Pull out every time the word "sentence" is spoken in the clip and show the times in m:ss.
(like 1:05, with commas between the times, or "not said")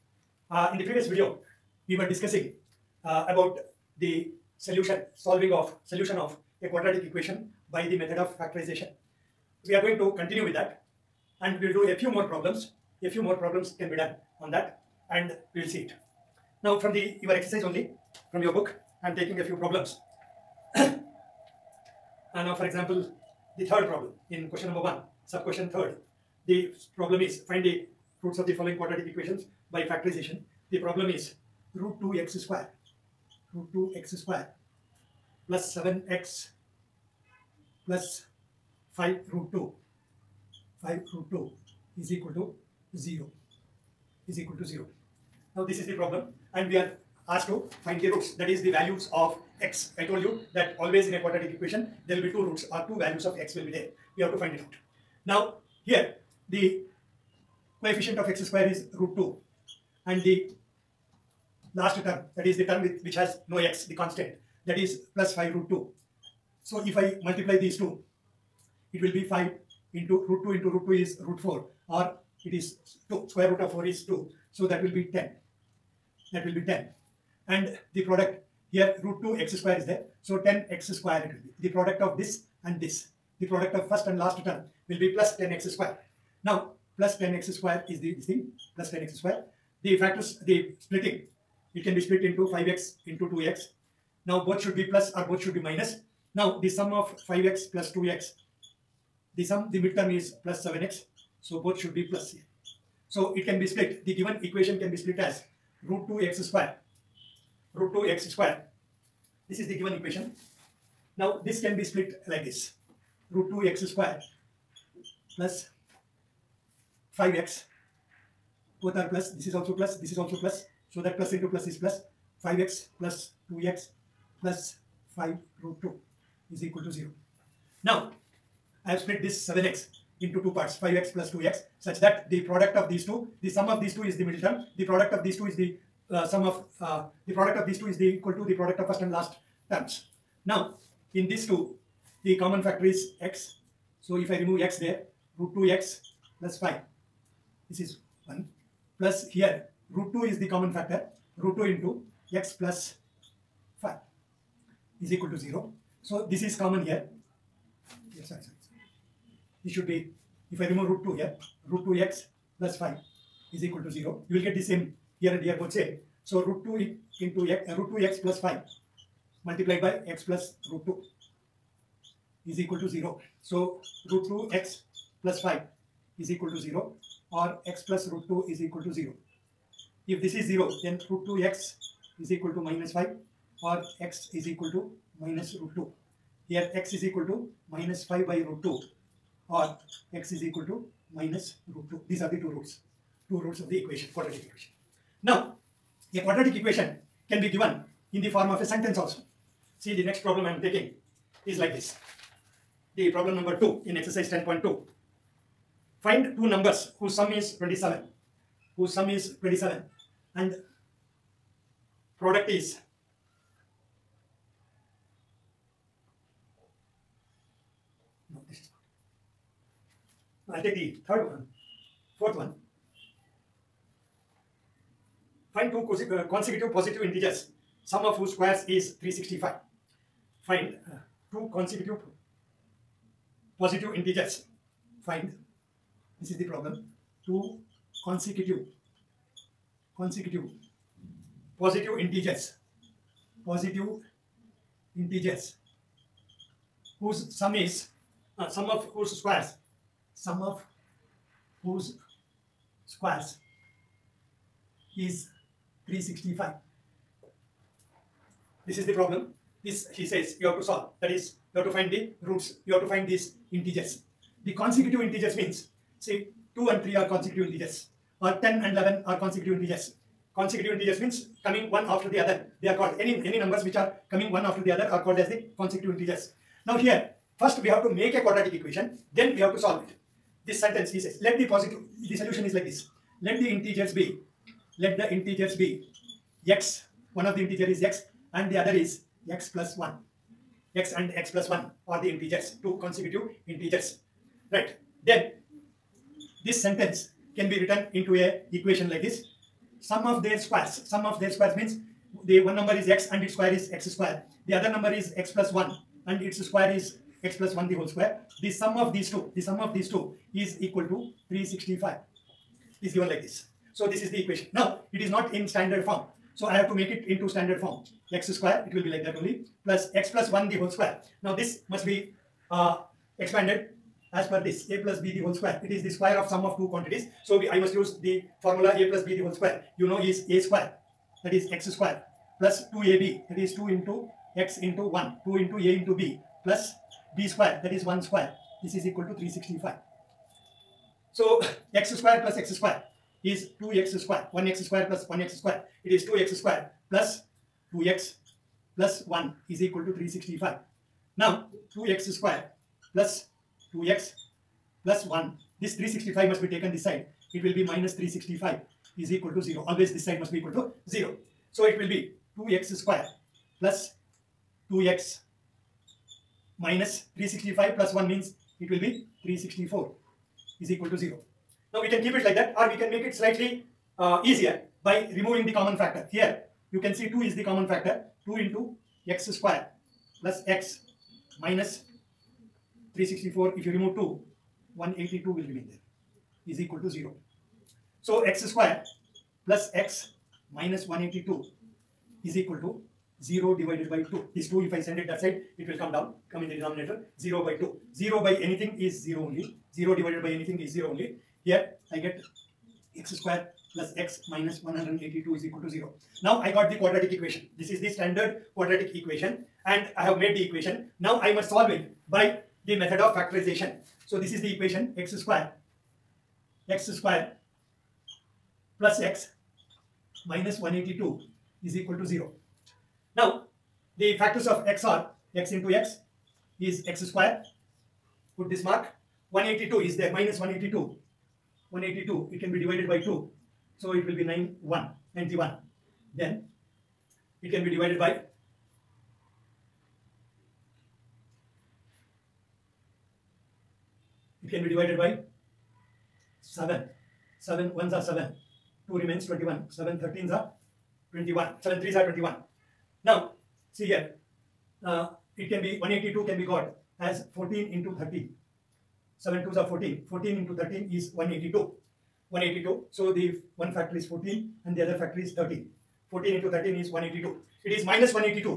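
3:18, 4:40, 4:56.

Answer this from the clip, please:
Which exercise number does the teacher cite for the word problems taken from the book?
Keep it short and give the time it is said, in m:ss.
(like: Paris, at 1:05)
10.2, at 3:23.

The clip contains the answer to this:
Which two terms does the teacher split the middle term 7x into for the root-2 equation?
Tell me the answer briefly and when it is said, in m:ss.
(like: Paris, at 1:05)
5x plus 2x, at 1:32.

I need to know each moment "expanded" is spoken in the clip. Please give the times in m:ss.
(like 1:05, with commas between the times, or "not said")
5:23.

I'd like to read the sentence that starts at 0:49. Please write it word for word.
I told you that always in a quadratic equation there will be two roots or two values of x will be there.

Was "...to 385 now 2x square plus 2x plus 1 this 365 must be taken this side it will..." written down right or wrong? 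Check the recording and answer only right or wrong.
wrong.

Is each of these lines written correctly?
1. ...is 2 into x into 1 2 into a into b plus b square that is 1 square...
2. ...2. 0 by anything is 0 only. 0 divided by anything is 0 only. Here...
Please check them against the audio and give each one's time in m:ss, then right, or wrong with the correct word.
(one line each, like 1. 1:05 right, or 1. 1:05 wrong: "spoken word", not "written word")
1. 5:33 right
2. 6:37 right.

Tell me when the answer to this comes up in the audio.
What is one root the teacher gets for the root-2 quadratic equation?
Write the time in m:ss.
3:07.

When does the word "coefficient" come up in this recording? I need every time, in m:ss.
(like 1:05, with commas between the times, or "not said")
0:57.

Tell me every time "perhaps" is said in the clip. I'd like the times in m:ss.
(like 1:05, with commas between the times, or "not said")
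not said.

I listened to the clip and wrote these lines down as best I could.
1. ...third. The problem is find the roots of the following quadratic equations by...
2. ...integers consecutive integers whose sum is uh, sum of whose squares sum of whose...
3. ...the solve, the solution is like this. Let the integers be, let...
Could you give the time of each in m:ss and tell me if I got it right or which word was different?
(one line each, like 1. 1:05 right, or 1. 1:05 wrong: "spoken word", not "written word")
1. 0:25 right
2. 4:01 wrong: "positive", not "consecutive"
3. 4:41 wrong: "positive", not "solve".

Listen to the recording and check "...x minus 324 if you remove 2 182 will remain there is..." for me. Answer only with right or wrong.
wrong.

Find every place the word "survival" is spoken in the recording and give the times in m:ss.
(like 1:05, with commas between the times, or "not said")
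not said.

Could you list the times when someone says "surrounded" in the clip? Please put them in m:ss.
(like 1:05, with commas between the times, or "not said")
not said.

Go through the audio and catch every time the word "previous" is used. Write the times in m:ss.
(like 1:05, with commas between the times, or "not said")
0:00.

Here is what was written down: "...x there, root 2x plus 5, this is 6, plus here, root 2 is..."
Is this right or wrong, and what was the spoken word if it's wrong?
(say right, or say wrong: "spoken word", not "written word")
wrong: "1", not "6".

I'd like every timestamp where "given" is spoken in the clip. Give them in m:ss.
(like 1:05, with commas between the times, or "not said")
1:44, 1:49, 3:17, 5:12.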